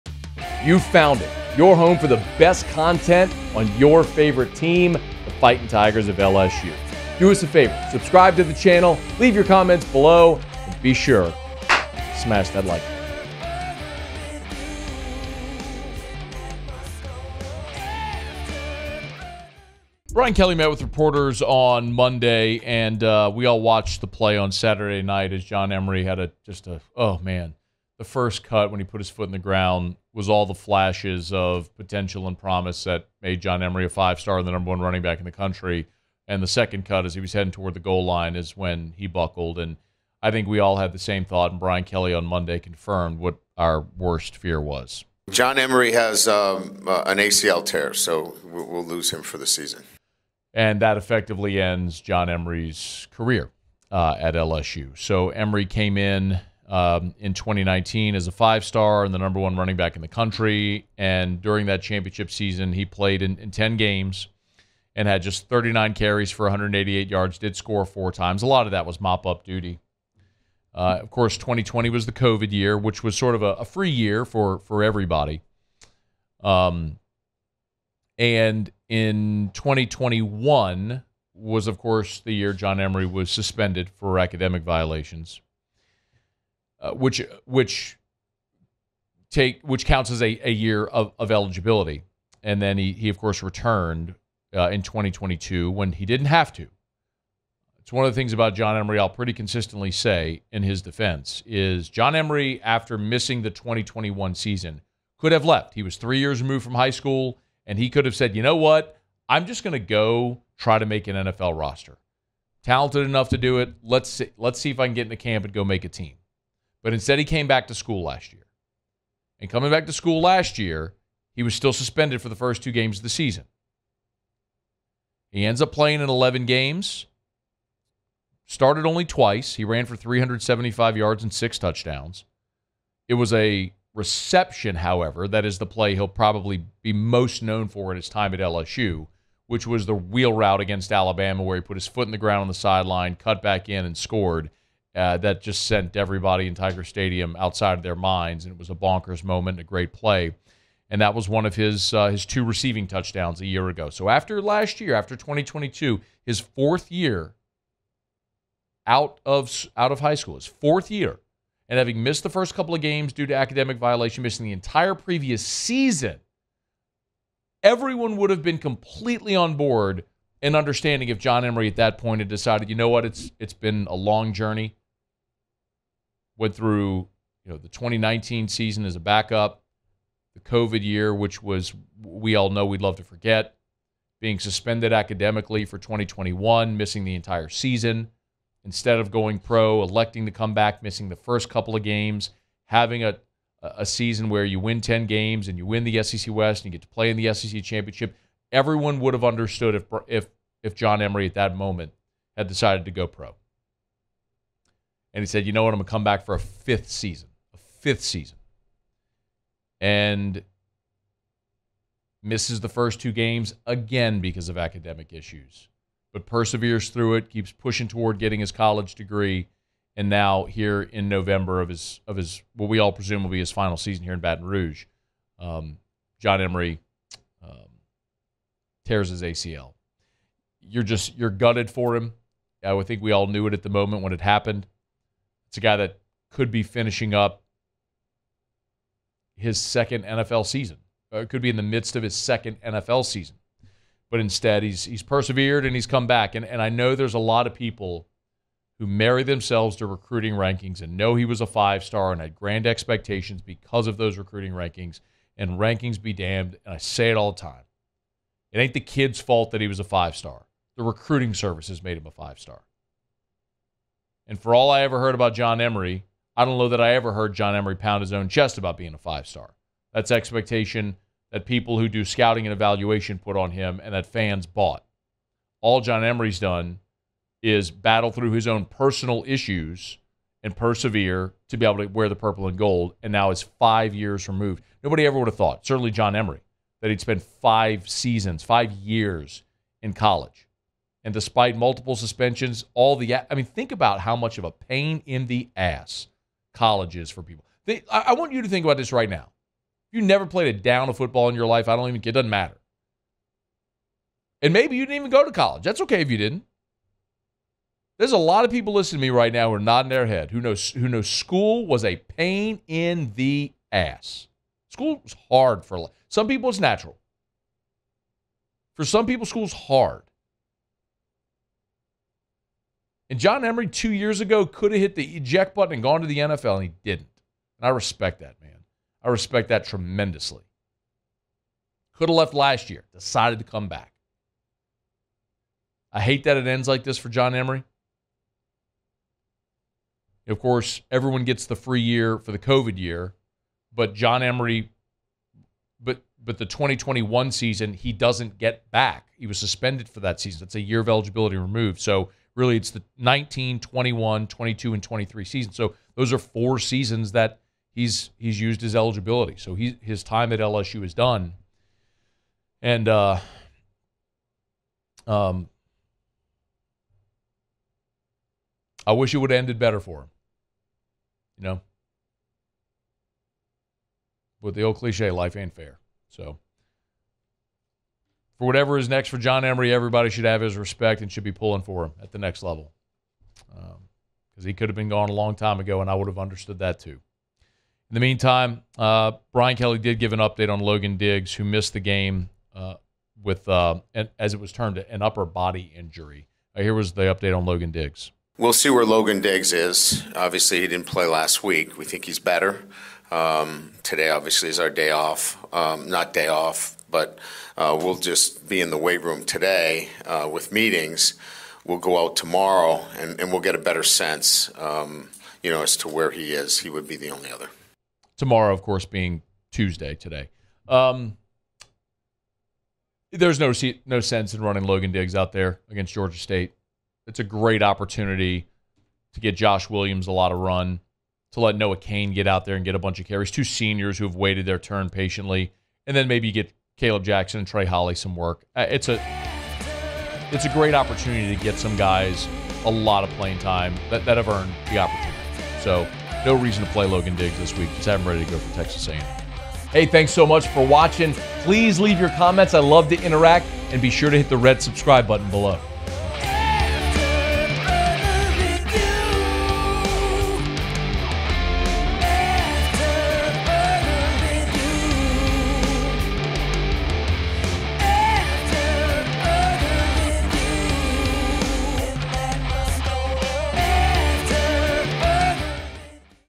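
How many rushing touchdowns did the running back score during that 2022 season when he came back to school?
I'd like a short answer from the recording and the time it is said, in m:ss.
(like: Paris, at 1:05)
6, at 2:11.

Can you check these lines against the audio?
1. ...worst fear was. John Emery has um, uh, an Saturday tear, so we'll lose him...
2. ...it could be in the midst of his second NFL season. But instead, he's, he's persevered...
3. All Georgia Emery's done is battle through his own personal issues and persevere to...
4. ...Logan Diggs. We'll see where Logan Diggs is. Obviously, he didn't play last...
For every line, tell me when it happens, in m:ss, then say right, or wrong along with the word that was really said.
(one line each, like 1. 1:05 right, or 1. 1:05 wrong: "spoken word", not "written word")
1. 0:43 wrong: "ACL", not "Saturday"
2. 4:01 right
3. 4:35 wrong: "John", not "Georgia"
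4. 6:37 right.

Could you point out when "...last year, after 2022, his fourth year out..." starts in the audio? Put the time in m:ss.
2:34.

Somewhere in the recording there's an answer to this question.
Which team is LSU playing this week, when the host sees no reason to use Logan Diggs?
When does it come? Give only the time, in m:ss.
7:05.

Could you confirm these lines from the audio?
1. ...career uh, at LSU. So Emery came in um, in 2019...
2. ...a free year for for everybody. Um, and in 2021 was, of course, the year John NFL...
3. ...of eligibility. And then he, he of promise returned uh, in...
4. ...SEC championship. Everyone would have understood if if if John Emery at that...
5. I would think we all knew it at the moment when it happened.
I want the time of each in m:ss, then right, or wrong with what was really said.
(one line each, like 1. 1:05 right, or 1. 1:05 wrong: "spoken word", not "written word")
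1. 0:53 right
2. 1:13 wrong: "Emery", not "NFL"
3. 1:31 wrong: "course", not "promise"
4. 3:17 right
5. 3:52 right.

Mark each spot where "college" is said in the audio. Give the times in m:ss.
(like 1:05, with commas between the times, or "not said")
3:38, 4:49, 4:56, 5:05.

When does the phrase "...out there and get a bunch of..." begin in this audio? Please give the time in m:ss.
7:12.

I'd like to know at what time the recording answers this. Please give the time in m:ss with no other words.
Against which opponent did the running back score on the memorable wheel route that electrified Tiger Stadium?
2:20.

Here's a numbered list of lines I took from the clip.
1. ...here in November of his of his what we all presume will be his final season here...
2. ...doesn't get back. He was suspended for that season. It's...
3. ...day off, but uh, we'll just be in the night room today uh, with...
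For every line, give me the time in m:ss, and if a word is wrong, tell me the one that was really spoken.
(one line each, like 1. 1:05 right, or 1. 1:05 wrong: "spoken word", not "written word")
1. 3:40 right
2. 5:47 right
3. 6:46 wrong: "weight", not "night".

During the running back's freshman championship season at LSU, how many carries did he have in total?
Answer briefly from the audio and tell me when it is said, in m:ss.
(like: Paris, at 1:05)
39, at 1:05.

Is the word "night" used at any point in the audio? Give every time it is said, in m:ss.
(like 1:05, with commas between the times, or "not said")
0:25.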